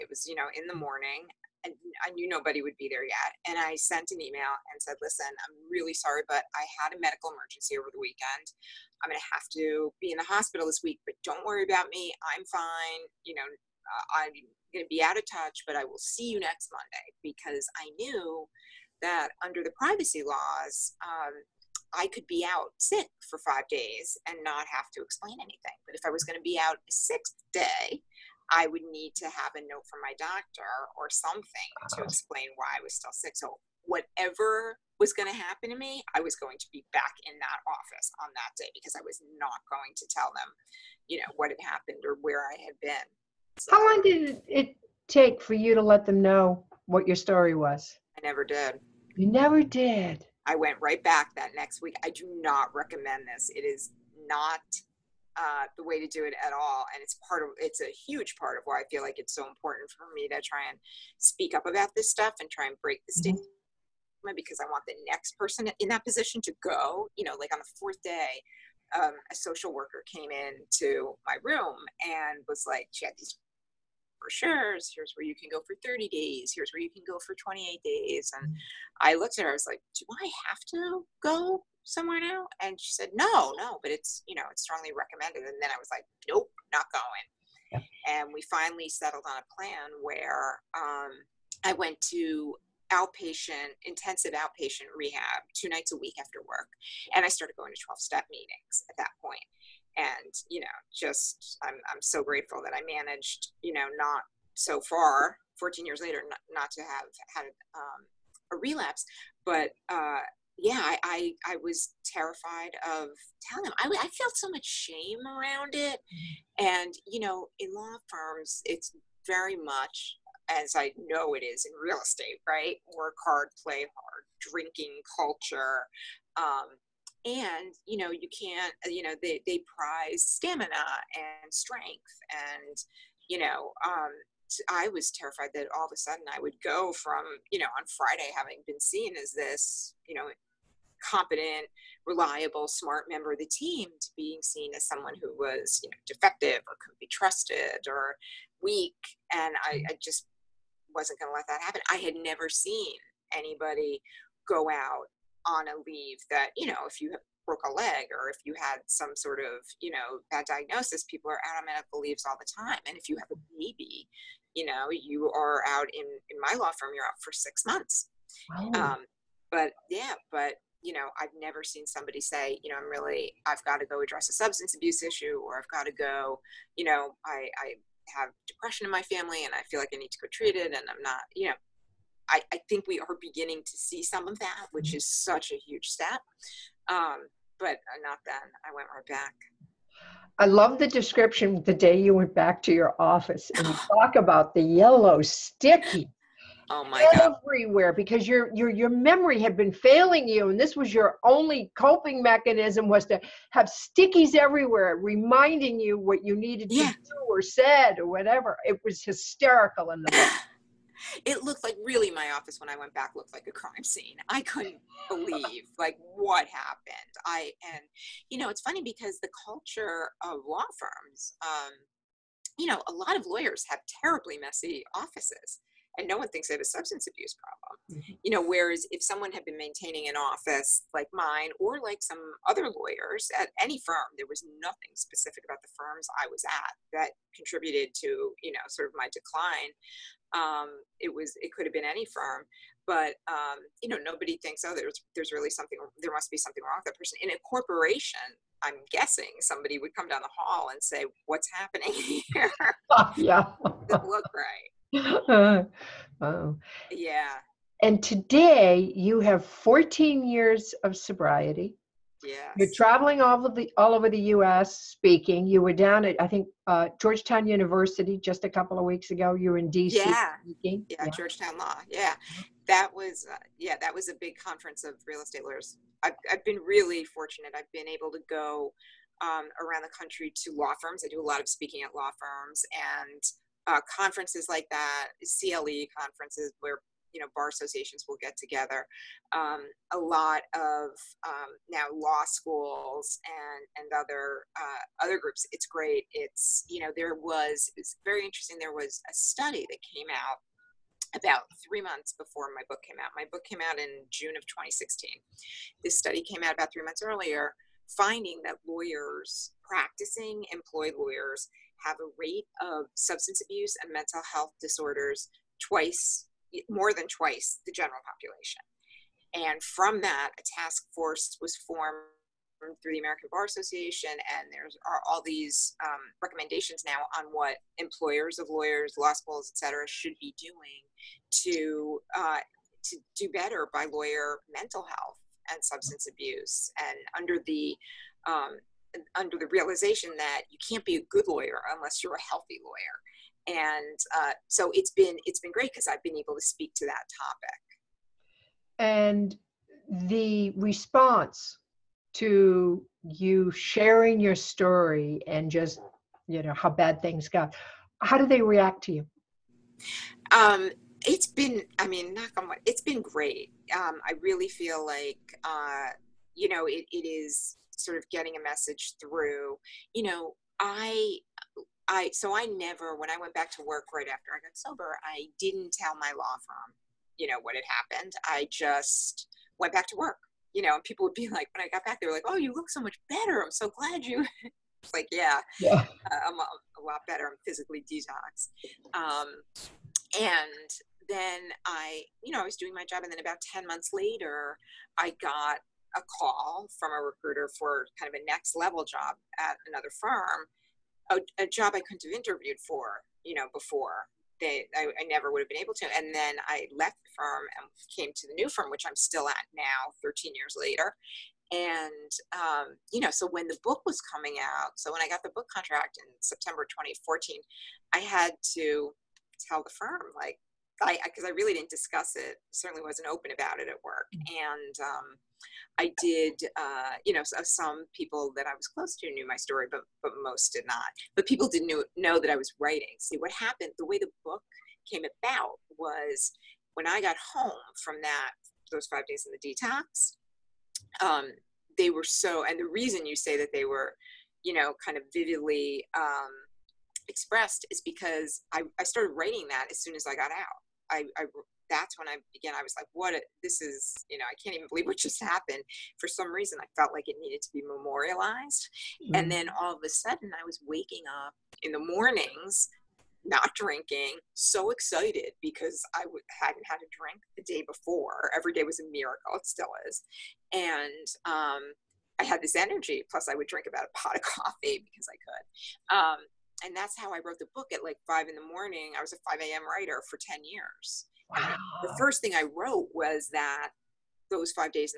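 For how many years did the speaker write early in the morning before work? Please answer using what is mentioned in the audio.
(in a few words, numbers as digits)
10 years.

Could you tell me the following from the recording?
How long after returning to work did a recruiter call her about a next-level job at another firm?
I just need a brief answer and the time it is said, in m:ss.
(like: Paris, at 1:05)
10 months, at 6:33.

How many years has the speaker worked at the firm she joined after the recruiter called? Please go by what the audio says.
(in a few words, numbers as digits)
13 years.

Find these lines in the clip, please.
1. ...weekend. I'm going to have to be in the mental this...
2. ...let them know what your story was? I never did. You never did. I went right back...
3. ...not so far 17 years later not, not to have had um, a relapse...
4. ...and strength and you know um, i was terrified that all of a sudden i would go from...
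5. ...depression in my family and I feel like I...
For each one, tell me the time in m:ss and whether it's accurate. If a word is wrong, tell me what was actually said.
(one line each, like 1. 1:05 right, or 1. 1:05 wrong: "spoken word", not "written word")
1. 0:07 wrong: "hospital", not "mental"
2. 0:45 right
3. 1:43 wrong: "14", not "17"
4. 2:11 right
5. 2:58 right.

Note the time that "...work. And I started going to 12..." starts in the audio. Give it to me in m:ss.
1:36.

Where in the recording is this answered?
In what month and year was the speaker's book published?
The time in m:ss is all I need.
5:04.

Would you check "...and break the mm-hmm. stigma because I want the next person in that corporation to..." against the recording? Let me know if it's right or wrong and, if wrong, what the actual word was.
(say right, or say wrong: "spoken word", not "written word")
wrong: "position", not "corporation".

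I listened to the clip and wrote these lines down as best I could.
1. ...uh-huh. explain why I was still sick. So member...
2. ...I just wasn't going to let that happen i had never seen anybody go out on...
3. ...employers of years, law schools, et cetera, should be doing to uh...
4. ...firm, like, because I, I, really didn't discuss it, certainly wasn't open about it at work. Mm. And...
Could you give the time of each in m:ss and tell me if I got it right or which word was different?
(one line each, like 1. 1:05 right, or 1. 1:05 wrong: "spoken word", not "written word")
1. 0:31 wrong: "whatever", not "member"
2. 2:29 right
3. 5:27 wrong: "lawyers", not "years"
4. 6:59 right.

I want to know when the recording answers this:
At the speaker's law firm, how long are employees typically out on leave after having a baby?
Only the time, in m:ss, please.
2:47.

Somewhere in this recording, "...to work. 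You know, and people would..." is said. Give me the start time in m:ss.
6:19.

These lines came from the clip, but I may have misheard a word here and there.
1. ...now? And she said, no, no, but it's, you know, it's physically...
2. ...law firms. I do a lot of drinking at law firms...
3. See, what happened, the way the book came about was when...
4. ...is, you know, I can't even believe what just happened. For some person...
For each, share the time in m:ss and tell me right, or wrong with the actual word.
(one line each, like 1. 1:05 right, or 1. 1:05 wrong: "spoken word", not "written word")
1. 1:22 wrong: "strongly", not "physically"
2. 4:40 wrong: "speaking", not "drinking"
3. 7:12 right
4. 7:33 wrong: "reason", not "person".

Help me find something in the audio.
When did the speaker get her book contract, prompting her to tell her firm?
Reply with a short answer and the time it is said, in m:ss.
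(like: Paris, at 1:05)
September 2014, at 6:56.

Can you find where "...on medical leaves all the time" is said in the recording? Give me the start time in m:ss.
2:41.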